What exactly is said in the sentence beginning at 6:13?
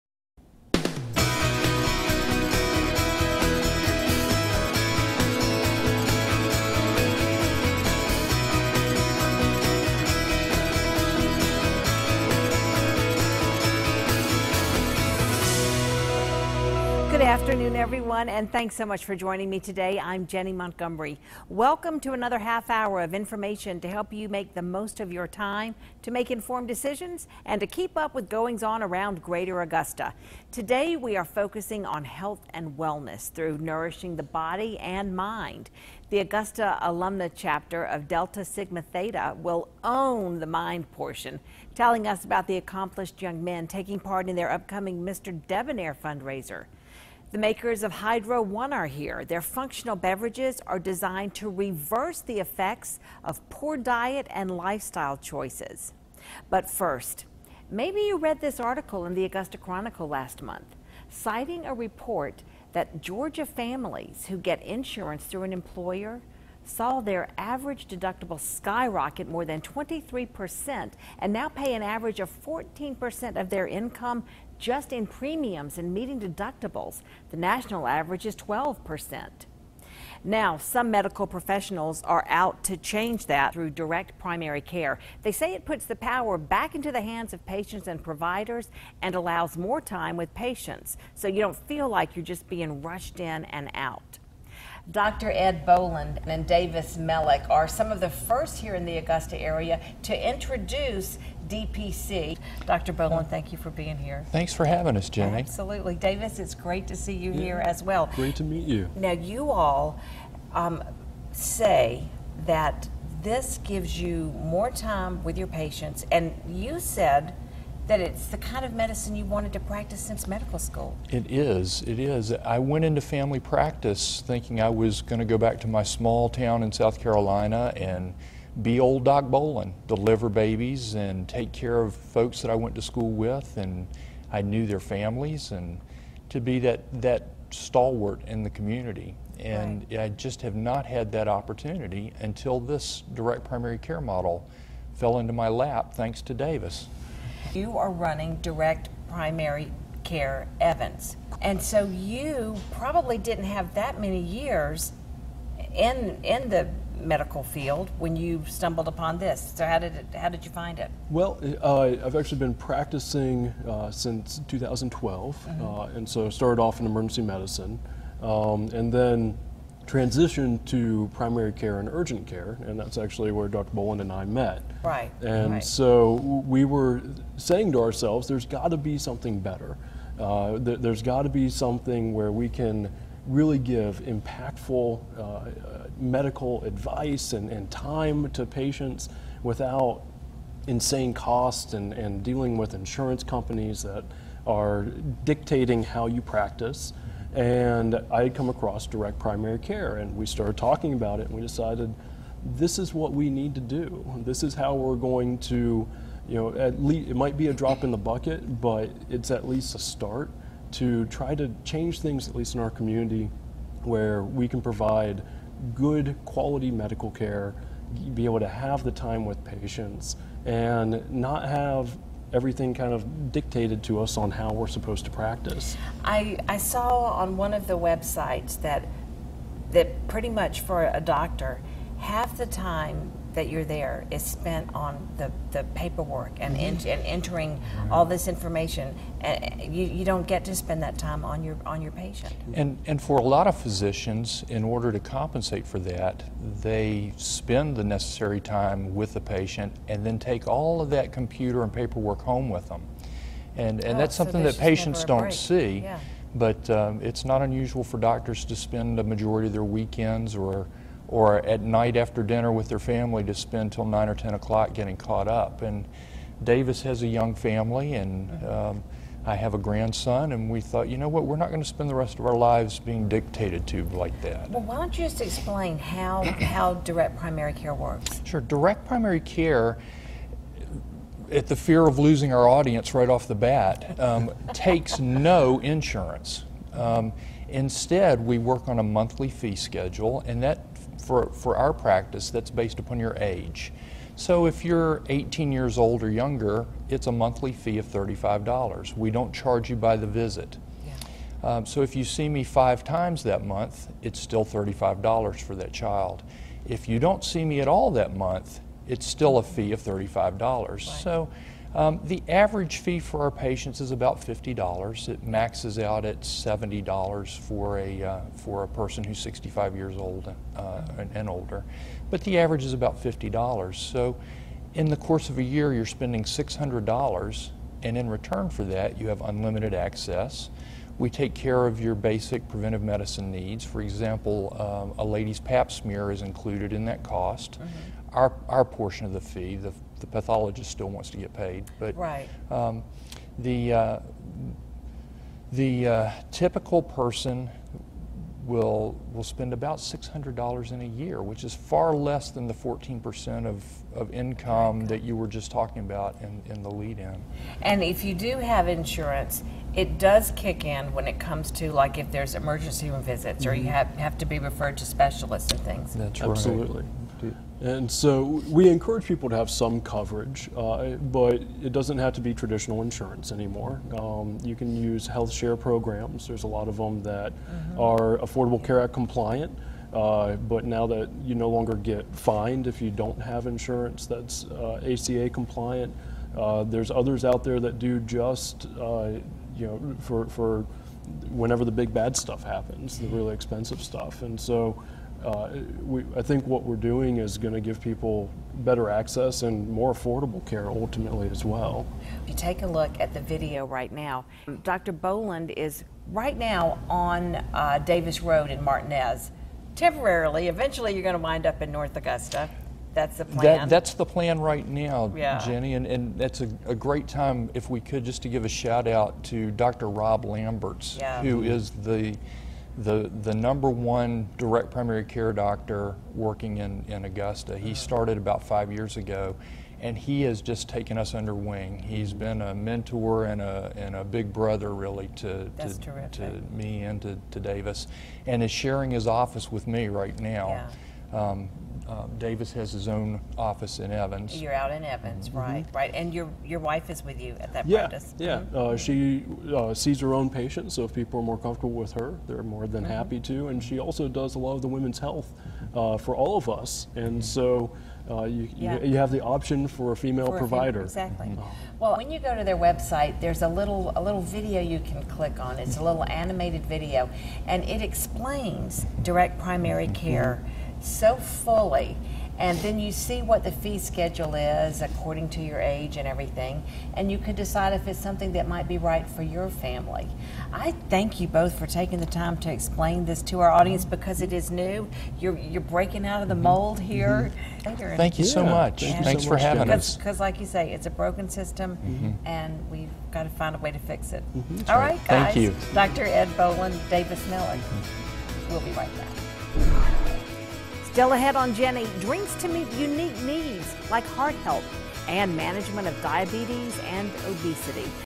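Um, you can use health share programs.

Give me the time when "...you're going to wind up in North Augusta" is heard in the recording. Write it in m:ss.
6:50.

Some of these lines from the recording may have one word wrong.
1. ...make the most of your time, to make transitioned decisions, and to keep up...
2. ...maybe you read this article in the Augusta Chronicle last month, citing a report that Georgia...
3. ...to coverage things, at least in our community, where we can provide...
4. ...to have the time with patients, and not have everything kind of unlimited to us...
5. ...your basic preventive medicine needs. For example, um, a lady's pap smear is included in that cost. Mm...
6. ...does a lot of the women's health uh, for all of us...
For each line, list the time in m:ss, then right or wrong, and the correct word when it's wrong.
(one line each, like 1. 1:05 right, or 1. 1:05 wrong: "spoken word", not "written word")
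1. 0:24 wrong: "informed", not "transitioned"
2. 0:57 right
3. 3:31 wrong: "change", not "coverage"
4. 3:38 wrong: "dictated", not "unlimited"
5. 5:31 right
6. 7:34 right.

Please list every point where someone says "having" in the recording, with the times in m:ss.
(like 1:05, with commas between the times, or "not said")
1:44, 8:09.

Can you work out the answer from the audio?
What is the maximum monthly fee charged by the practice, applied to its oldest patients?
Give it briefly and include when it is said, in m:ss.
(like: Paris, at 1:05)
$70, at 5:16.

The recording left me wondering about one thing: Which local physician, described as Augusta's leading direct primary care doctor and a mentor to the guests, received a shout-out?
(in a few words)
Rob Lamberts.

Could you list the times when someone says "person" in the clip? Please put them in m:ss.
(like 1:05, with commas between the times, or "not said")
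5:18, 5:46.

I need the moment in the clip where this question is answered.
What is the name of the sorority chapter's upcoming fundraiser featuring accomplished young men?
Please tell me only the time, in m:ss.
0:45.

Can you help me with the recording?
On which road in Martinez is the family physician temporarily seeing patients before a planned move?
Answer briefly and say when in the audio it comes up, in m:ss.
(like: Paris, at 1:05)
Davis Road, at 6:47.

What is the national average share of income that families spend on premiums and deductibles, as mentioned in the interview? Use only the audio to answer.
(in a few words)
12%.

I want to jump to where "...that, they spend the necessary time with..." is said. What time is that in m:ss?
4:05.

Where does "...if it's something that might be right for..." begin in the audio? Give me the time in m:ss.
7:57.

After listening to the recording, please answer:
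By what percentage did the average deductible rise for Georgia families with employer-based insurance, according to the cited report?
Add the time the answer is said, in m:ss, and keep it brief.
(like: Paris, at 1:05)
23%, at 1:09.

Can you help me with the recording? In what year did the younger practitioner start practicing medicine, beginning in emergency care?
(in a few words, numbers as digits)
2012.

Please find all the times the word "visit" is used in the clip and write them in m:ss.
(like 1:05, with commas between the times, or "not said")
5:00, 6:03.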